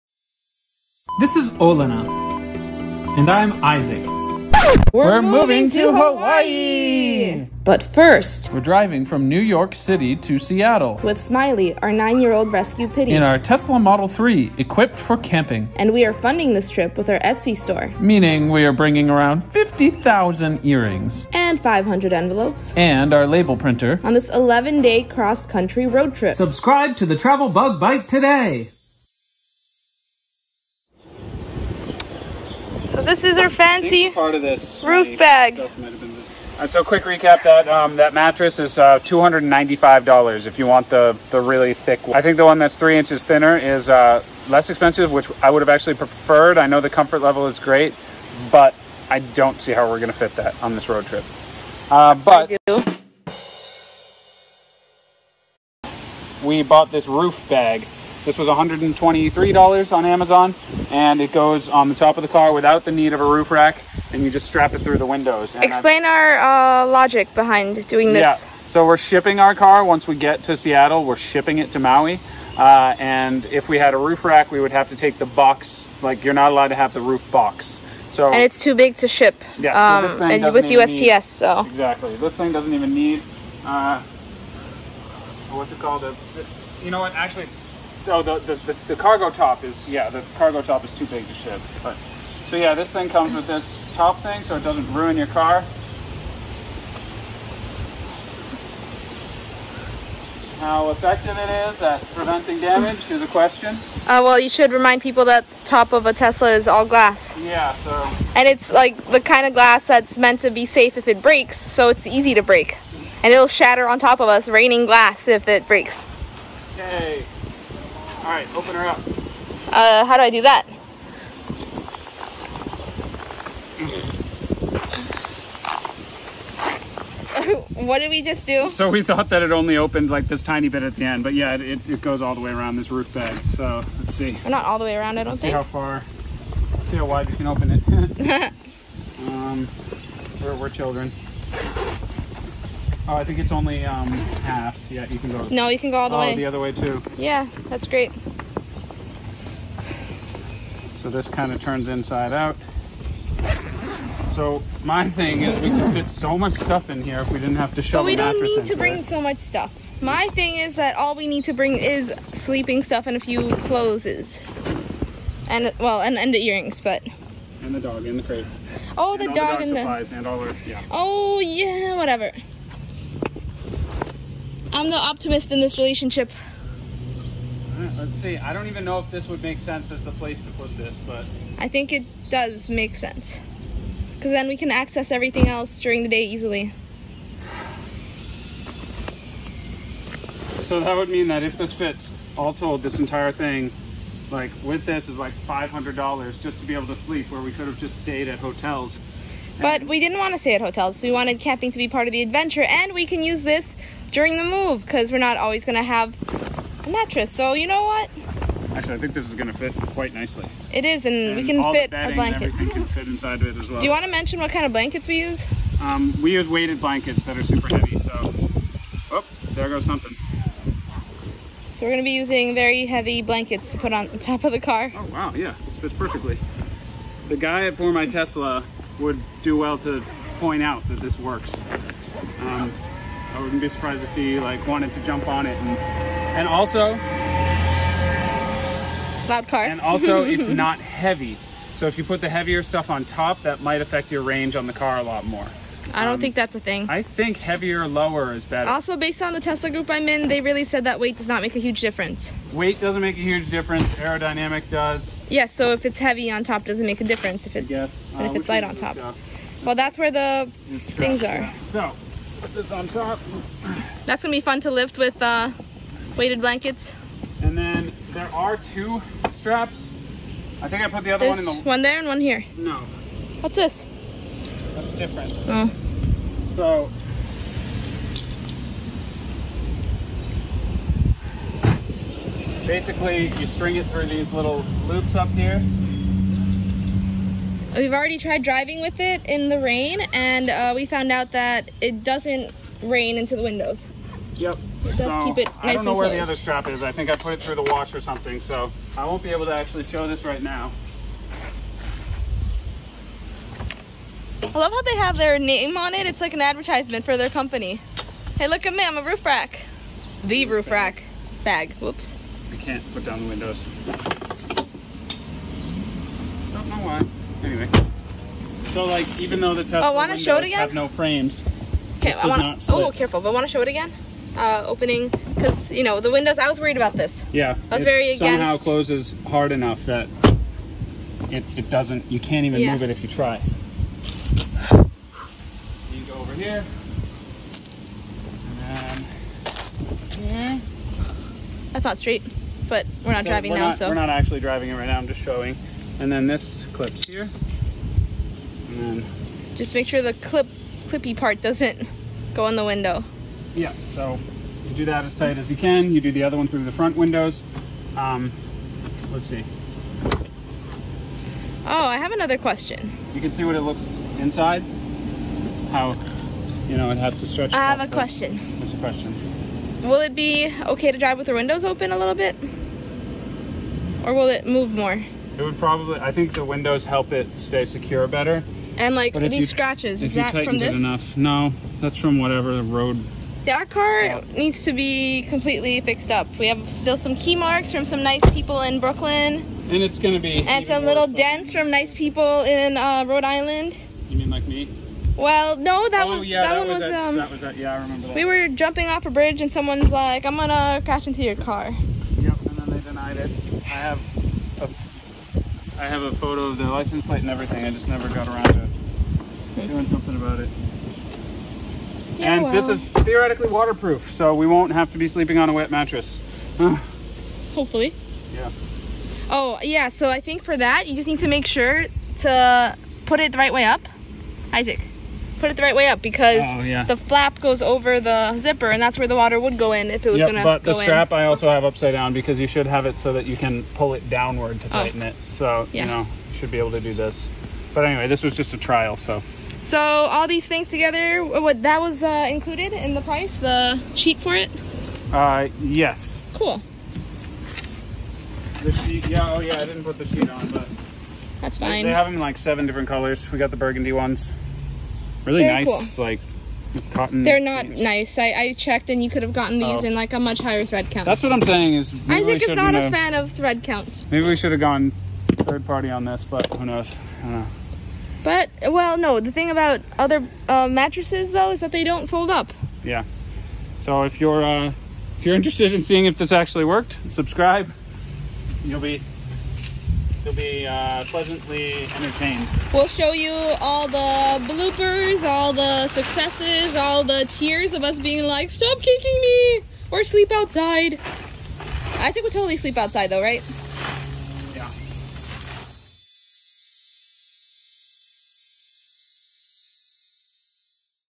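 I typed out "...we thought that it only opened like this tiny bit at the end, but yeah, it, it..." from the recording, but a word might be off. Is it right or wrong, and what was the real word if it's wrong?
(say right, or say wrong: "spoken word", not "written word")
right.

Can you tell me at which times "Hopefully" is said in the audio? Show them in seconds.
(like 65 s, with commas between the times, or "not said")
417 s.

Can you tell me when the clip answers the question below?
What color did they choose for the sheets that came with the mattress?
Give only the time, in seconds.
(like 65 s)
453 s.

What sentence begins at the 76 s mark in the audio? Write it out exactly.
Like you're not allowed to have the roof box.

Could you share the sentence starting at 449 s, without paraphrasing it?
Oh yeah, I didn't put the sheet on, but.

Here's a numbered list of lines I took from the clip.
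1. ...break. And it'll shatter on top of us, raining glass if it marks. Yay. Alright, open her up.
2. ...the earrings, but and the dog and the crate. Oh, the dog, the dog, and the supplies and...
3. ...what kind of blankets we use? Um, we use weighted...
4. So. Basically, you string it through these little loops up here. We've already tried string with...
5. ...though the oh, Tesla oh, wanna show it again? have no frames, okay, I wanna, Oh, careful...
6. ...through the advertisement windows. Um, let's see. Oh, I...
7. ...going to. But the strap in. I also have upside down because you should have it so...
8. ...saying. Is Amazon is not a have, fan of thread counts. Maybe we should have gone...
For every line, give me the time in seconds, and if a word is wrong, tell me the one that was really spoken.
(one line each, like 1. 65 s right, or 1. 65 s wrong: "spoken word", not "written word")
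1. 112 s wrong: "breaks", not "marks"
2. 166 s right
3. 214 s right
4. 276 s wrong: "driving", not "string"
5. 319 s right
6. 356 s wrong: "front", not "advertisement"
7. 430 s right
8. 461 s wrong: "Isaac", not "Amazon".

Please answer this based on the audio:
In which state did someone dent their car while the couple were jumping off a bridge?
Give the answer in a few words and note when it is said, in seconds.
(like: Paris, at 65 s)
Rhode Island, at 393 s.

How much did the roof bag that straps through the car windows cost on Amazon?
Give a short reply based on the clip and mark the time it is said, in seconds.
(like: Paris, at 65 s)
$123, at 58 s.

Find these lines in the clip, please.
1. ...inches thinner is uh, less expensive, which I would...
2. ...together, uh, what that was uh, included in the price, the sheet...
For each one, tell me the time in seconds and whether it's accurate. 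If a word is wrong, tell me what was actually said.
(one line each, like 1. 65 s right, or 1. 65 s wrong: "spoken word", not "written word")
1. 42 s right
2. 440 s right.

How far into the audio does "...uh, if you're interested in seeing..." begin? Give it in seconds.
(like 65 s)
474 s.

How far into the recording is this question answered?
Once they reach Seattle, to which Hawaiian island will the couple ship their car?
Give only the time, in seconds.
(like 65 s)
71 s.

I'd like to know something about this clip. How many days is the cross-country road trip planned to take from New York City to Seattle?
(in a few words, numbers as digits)
11.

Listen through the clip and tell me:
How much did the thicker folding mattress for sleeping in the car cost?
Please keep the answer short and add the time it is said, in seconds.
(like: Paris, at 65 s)
$295, at 38 s.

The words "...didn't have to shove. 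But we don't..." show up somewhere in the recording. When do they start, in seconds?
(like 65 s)
157 s.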